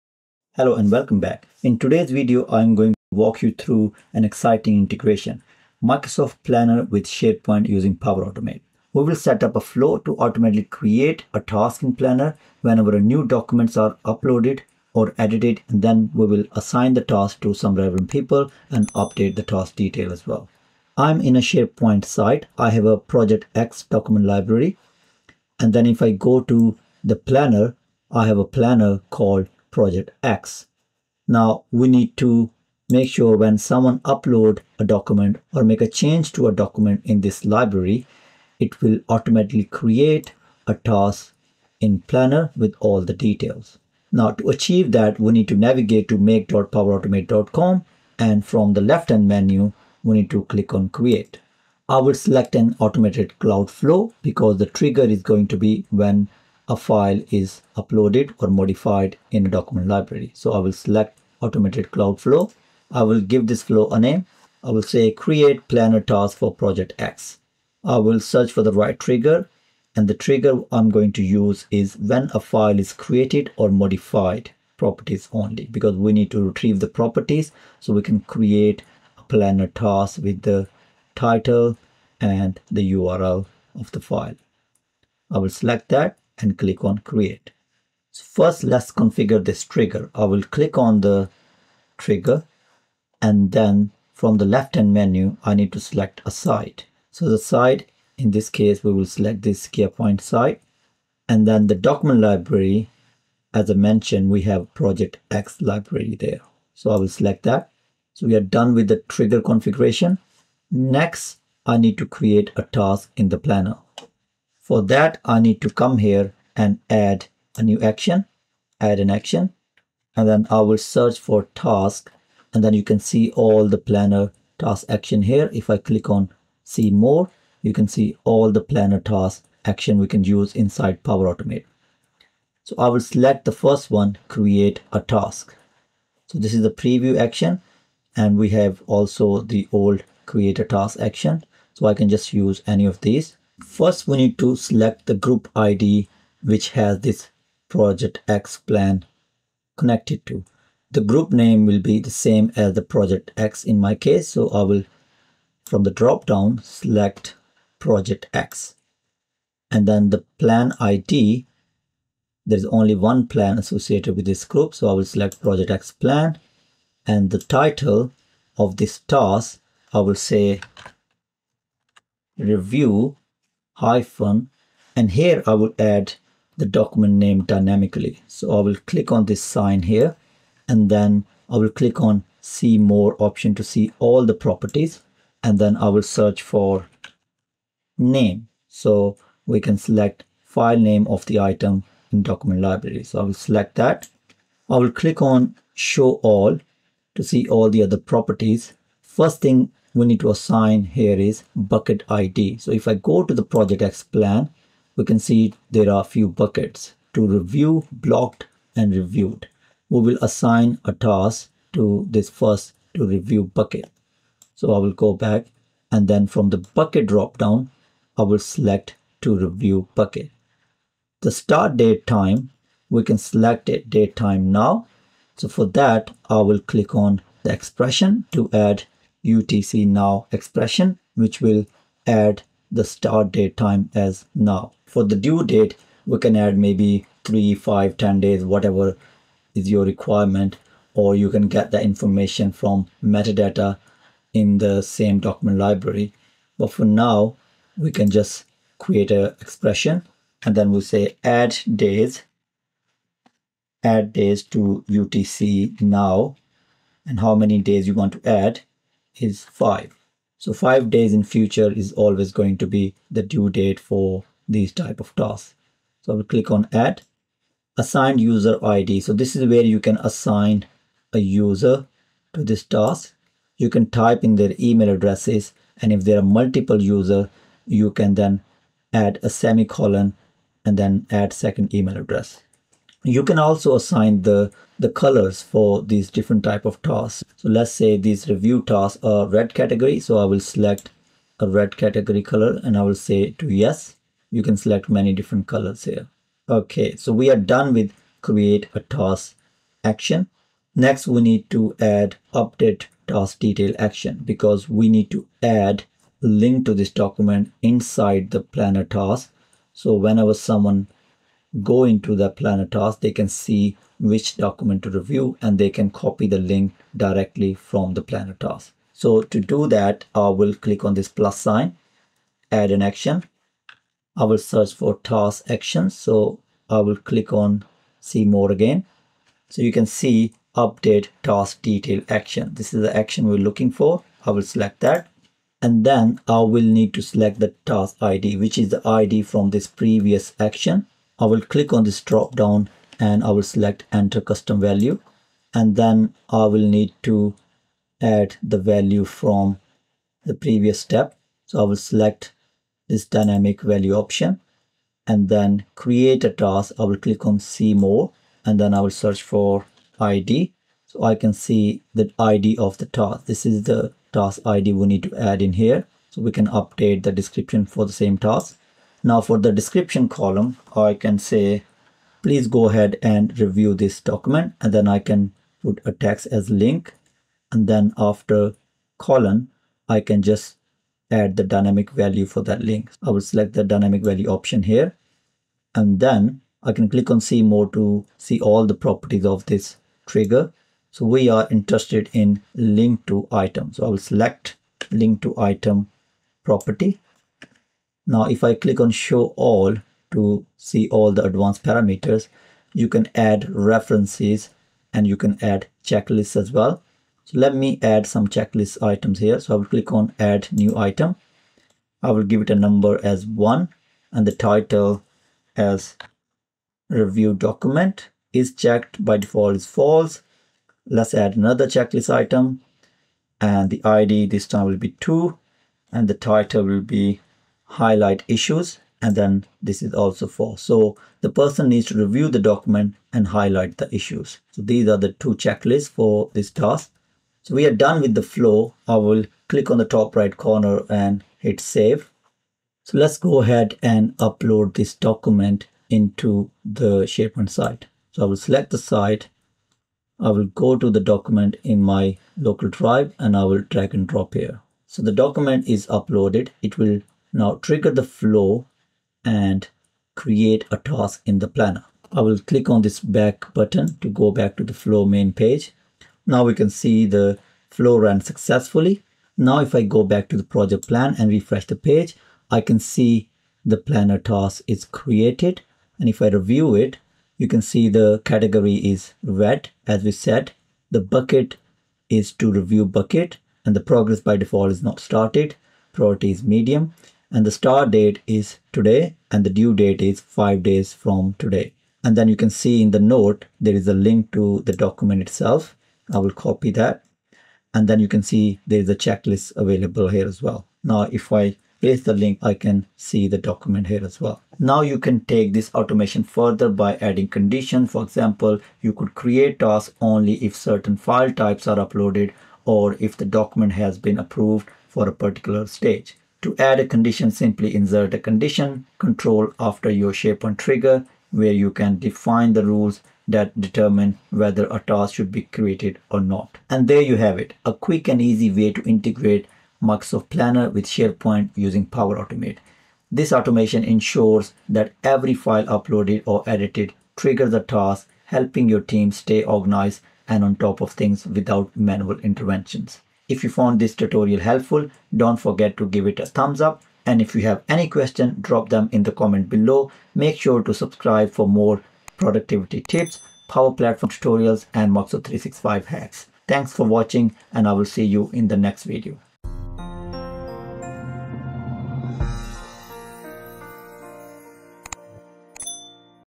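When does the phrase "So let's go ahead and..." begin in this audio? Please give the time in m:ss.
7:22.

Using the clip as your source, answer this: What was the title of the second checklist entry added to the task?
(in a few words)
Highlight issues.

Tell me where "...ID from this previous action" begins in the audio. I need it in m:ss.
5:38.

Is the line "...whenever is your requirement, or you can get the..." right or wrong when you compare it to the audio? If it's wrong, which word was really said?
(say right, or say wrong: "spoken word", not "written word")
wrong: "whatever", not "whenever".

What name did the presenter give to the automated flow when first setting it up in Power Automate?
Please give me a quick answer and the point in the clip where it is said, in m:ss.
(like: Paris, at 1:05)
Create planner task for project X, at 1:05.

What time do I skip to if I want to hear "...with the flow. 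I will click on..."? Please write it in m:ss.
7:18.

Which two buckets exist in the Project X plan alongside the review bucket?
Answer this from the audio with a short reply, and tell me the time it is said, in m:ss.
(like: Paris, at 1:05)
Blocked and reviewed, at 3:27.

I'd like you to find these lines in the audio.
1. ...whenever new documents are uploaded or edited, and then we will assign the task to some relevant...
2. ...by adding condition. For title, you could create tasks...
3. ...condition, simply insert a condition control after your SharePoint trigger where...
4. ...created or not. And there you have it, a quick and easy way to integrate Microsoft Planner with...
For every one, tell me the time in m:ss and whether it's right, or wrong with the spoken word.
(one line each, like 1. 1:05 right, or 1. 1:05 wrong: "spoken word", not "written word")
1. 0:12 right
2. 8:26 wrong: "example", not "title"
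3. 8:36 right
4. 8:45 right.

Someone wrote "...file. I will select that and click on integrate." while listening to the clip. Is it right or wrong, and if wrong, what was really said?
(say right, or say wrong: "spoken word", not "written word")
wrong: "create", not "integrate".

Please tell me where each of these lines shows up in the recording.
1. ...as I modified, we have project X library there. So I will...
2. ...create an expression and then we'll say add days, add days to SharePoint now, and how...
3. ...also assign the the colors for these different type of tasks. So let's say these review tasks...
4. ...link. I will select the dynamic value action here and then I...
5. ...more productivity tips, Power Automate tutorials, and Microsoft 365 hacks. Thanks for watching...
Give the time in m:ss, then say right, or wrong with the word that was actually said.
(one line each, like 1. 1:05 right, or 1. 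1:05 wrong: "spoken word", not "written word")
1. 1:43 wrong: "mentioned", not "modified"
2. 4:08 wrong: "UTC", not "SharePoint"
3. 4:43 right
4. 6:22 wrong: "option", not "action"
5. 9:11 wrong: "Platform", not "Automate".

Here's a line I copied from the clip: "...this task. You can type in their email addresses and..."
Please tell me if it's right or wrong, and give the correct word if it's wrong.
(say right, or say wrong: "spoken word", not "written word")
right.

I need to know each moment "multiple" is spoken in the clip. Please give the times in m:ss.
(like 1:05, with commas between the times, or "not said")
4:36.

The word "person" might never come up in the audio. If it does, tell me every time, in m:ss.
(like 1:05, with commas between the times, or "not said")
7:11.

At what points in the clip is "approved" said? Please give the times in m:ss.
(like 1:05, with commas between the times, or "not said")
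8:34.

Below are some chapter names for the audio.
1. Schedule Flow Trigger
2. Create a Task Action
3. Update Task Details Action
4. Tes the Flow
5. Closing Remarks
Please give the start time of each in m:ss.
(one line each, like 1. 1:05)
1. 0:46
2. 1:53
3. 5:00
4. 7:23
5. 8:25.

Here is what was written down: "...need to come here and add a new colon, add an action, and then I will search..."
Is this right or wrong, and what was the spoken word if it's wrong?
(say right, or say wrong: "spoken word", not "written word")
wrong: "action", not "colon".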